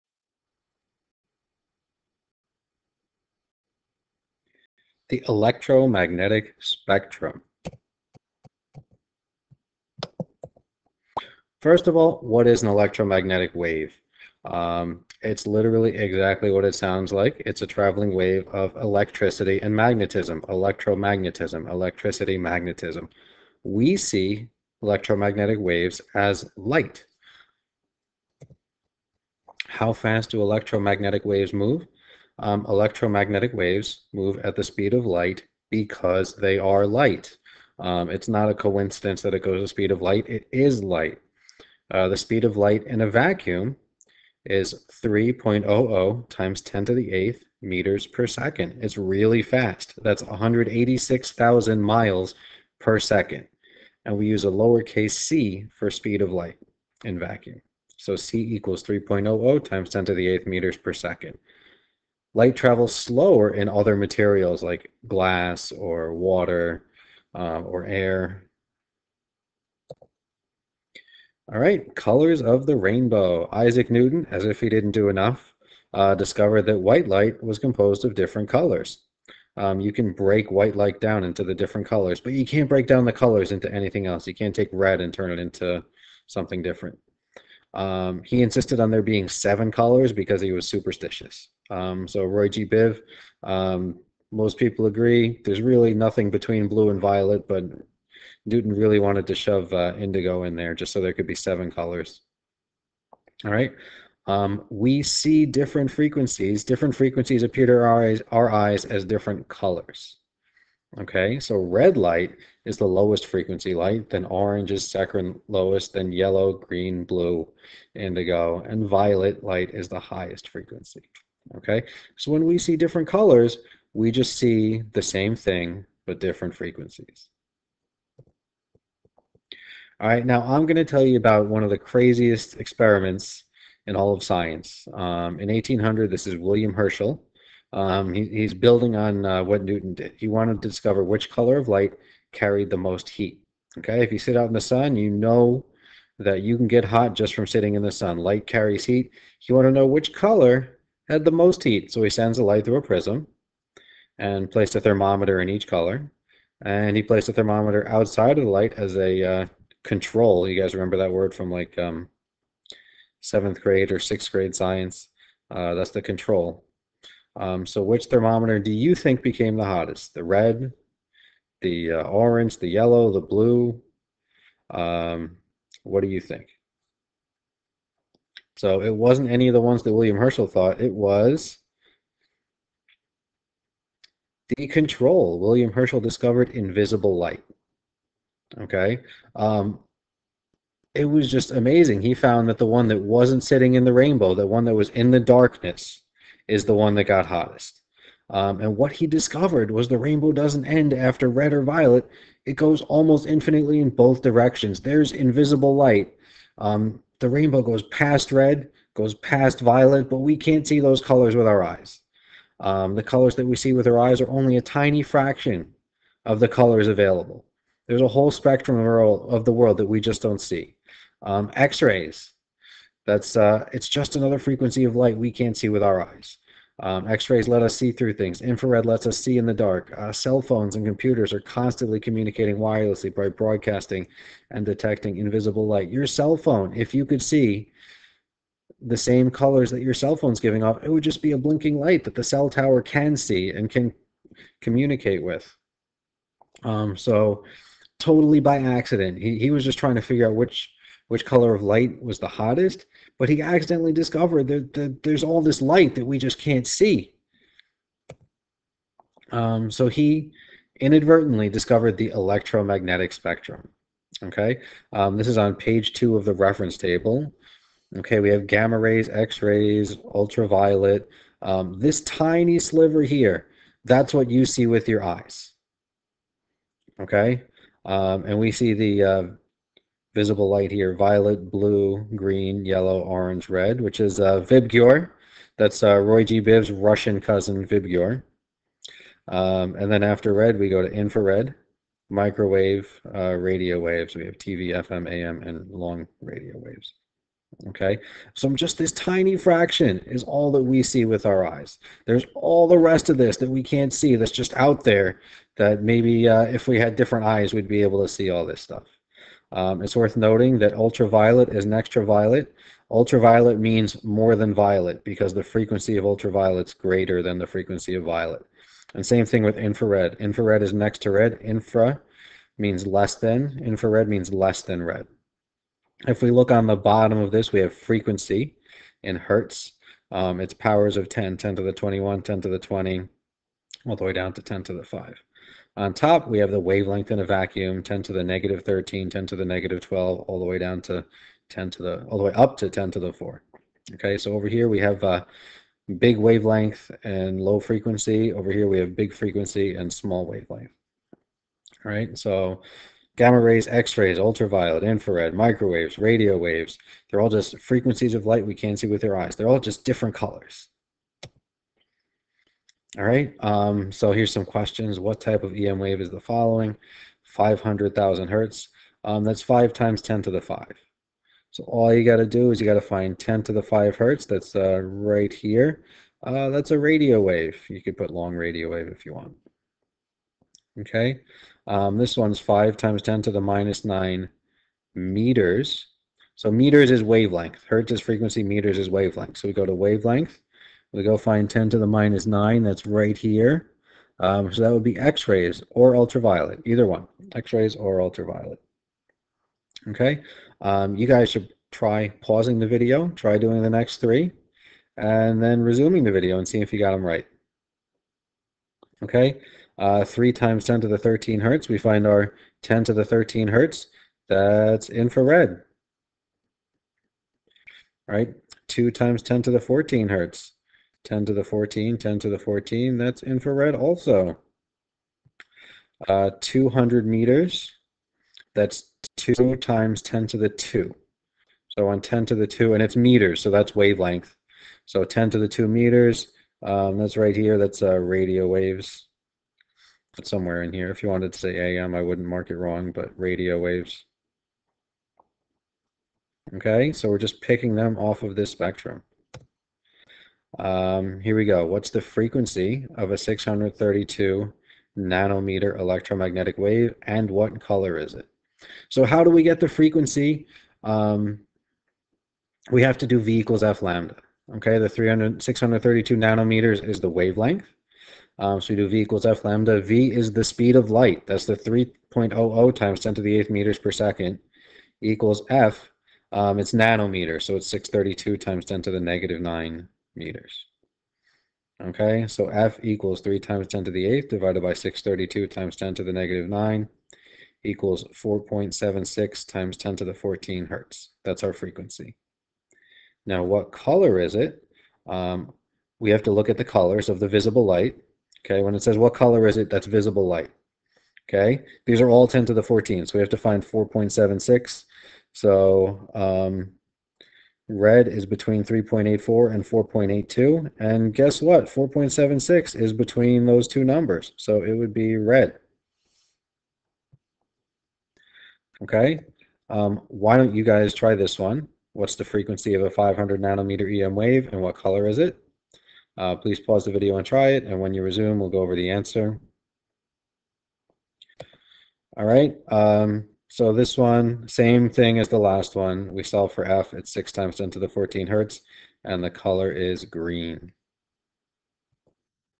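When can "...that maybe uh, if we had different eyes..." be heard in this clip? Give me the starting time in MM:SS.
05:05.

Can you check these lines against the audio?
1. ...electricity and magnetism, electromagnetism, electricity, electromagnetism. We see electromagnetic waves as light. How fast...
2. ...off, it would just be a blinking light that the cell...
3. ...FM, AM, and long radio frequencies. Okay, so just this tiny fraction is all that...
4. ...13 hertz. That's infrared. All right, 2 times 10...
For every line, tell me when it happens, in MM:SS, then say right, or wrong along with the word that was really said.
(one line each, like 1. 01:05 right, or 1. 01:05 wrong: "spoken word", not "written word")
1. 00:18 wrong: "magnetism", not "electromagnetism"
2. 04:00 right
3. 04:54 wrong: "waves", not "frequencies"
4. 06:53 right.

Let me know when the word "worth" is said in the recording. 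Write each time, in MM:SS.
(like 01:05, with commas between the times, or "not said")
05:09.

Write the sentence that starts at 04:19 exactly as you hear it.
Um, so he inadvertently discovered the electromagnetic spectrum.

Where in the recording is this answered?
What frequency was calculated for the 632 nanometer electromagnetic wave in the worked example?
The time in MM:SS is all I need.
08:08.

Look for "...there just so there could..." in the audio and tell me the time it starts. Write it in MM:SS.
01:40.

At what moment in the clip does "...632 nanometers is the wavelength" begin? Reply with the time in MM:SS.
07:45.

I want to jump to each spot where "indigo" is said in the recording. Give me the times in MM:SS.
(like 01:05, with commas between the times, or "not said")
01:39, 01:57.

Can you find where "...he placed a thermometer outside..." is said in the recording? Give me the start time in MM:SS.
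02:36.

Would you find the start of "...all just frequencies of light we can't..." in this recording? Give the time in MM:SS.
05:57.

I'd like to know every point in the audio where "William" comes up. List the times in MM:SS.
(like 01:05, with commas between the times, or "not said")
02:16, 02:59, 03:05.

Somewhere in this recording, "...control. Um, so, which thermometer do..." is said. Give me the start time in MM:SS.
02:46.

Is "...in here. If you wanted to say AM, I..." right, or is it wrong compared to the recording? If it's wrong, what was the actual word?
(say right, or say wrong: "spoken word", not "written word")
right.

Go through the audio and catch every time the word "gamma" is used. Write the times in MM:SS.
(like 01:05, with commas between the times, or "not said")
04:28, 05:53.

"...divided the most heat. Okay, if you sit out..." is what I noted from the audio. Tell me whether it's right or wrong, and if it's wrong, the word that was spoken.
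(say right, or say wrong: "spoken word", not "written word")
wrong: "carried", not "divided".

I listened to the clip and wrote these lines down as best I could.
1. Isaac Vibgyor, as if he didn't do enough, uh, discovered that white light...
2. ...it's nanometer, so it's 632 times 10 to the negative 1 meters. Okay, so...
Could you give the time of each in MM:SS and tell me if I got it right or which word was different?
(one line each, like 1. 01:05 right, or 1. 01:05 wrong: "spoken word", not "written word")
1. 01:13 wrong: "Newton", not "Vibgyor"
2. 07:56 wrong: "9", not "1".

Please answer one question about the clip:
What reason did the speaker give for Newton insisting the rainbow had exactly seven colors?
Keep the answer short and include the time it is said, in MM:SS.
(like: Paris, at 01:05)
He was superstitious, at 01:30.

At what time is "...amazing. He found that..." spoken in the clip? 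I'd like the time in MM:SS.
03:11.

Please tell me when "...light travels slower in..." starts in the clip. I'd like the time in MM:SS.
01:02.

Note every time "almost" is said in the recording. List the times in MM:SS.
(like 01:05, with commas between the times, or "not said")
03:22.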